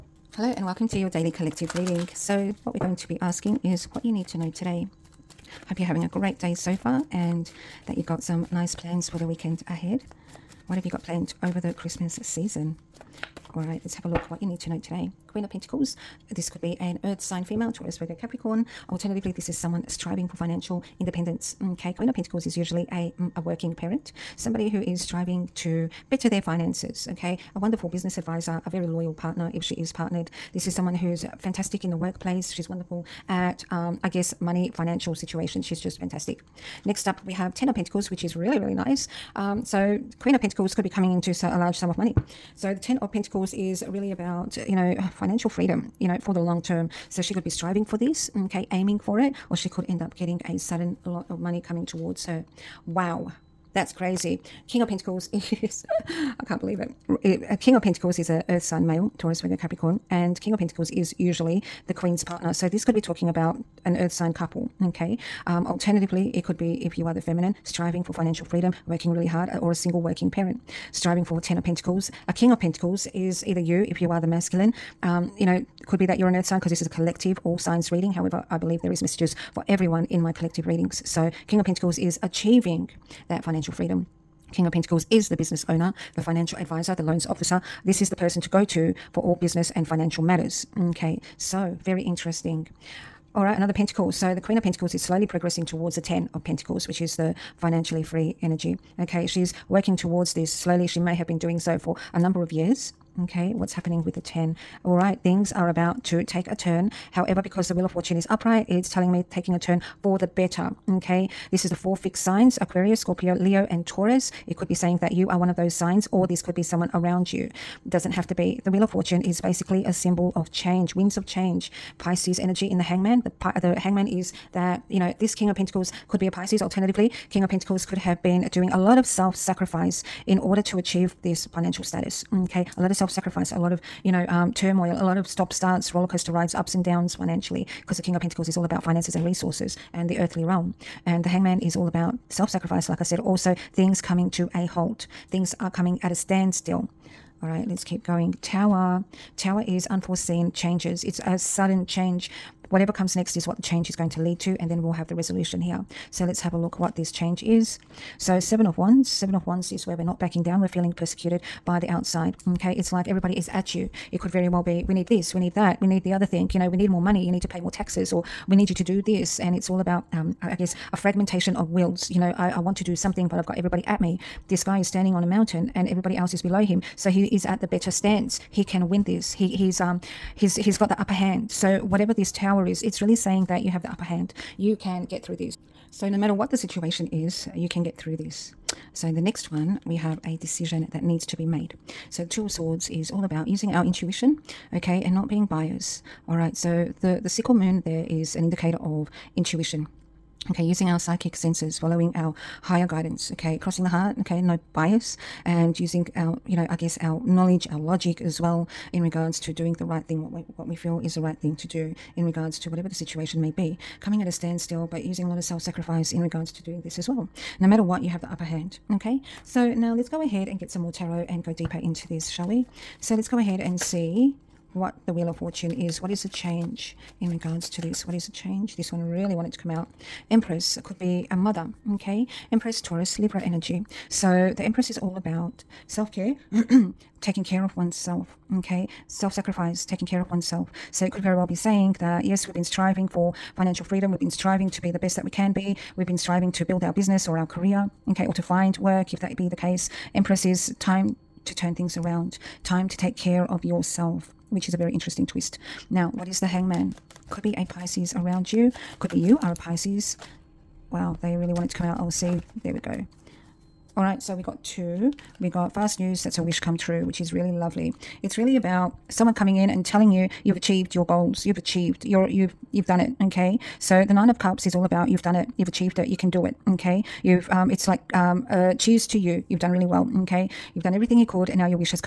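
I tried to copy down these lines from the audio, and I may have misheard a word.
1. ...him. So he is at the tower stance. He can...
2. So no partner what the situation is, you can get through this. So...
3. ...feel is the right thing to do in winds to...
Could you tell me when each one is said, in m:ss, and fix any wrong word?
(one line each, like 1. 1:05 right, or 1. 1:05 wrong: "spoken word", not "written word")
1. 2:56 wrong: "better", not "tower"
2. 3:05 wrong: "matter", not "partner"
3. 3:30 wrong: "regards", not "winds".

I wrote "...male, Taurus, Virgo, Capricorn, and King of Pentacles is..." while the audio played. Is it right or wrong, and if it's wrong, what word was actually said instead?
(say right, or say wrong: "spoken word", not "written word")
right.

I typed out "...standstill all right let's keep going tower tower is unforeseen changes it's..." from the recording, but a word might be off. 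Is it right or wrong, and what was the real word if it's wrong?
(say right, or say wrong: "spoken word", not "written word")
right.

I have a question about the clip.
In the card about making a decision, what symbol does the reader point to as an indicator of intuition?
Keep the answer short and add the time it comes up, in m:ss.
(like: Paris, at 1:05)
Sickle moon, at 3:17.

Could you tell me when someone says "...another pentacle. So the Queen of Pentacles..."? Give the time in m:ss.
1:33.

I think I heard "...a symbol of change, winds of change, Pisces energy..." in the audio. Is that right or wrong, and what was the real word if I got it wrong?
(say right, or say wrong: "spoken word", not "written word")
right.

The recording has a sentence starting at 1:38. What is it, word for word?
Okay, she's working towards this slowly.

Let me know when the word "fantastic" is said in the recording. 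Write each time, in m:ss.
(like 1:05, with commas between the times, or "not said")
0:31, 0:35.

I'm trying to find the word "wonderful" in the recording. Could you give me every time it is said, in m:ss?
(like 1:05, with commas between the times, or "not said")
0:27, 0:32.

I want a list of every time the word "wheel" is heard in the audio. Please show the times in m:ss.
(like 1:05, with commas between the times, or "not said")
1:47, 1:58, 3:45.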